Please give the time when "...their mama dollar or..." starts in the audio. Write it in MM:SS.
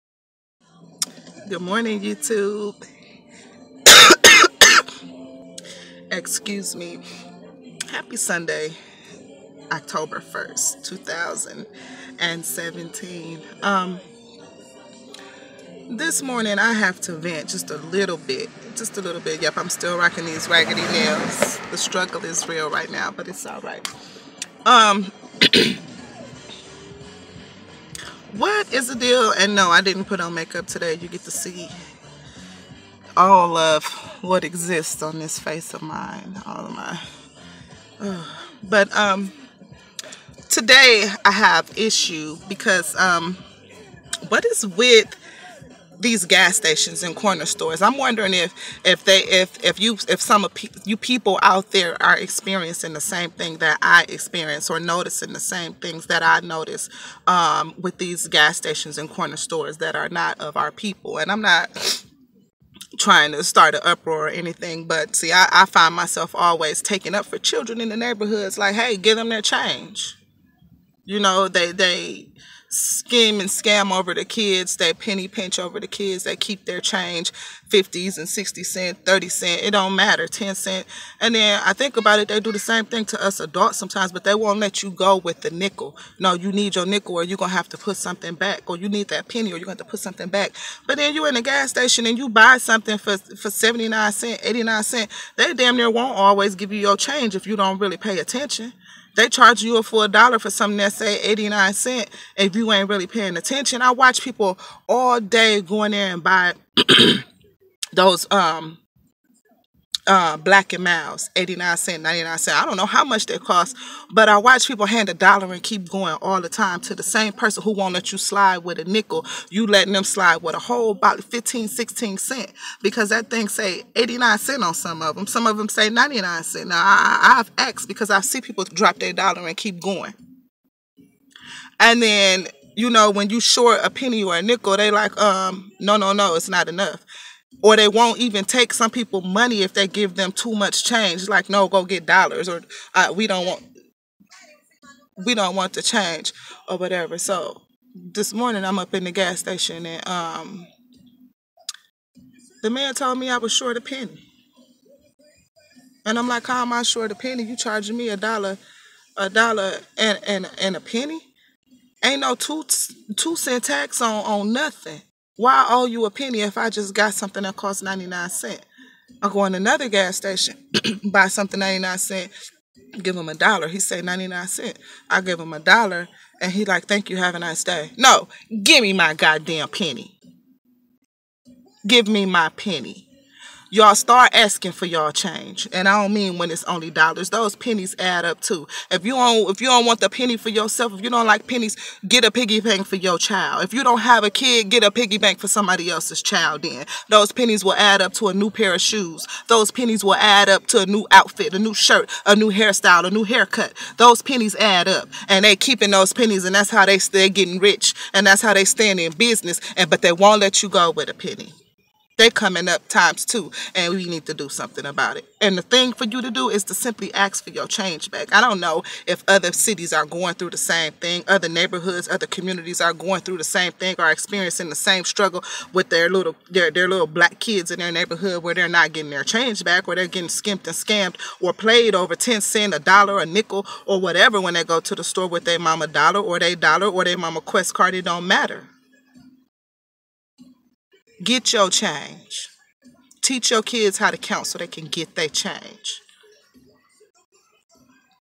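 03:55.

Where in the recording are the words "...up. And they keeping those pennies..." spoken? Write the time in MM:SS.
03:24.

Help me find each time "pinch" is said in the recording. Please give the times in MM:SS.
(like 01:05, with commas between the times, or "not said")
01:15.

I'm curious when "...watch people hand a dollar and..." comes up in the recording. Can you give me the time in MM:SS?
01:54.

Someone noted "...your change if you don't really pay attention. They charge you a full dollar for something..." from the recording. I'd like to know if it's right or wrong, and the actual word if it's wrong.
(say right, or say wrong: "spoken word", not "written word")
right.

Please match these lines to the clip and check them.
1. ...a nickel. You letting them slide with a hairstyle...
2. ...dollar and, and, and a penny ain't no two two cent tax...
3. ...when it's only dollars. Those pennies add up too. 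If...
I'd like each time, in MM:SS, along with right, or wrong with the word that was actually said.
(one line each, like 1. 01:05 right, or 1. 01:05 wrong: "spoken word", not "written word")
1. 01:58 wrong: "whole", not "hairstyle"
2. 02:39 right
3. 03:06 right.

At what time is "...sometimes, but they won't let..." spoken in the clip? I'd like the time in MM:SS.
01:23.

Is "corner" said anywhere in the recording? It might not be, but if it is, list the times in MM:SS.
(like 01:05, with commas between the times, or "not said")
00:47, 00:59.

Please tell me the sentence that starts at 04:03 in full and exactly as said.
Teach your kids how to count so they can get their change.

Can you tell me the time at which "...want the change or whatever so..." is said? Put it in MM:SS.
02:25.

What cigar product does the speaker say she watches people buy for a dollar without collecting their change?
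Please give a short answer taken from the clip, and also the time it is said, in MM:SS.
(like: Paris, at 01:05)
Black and Milds, at 01:50.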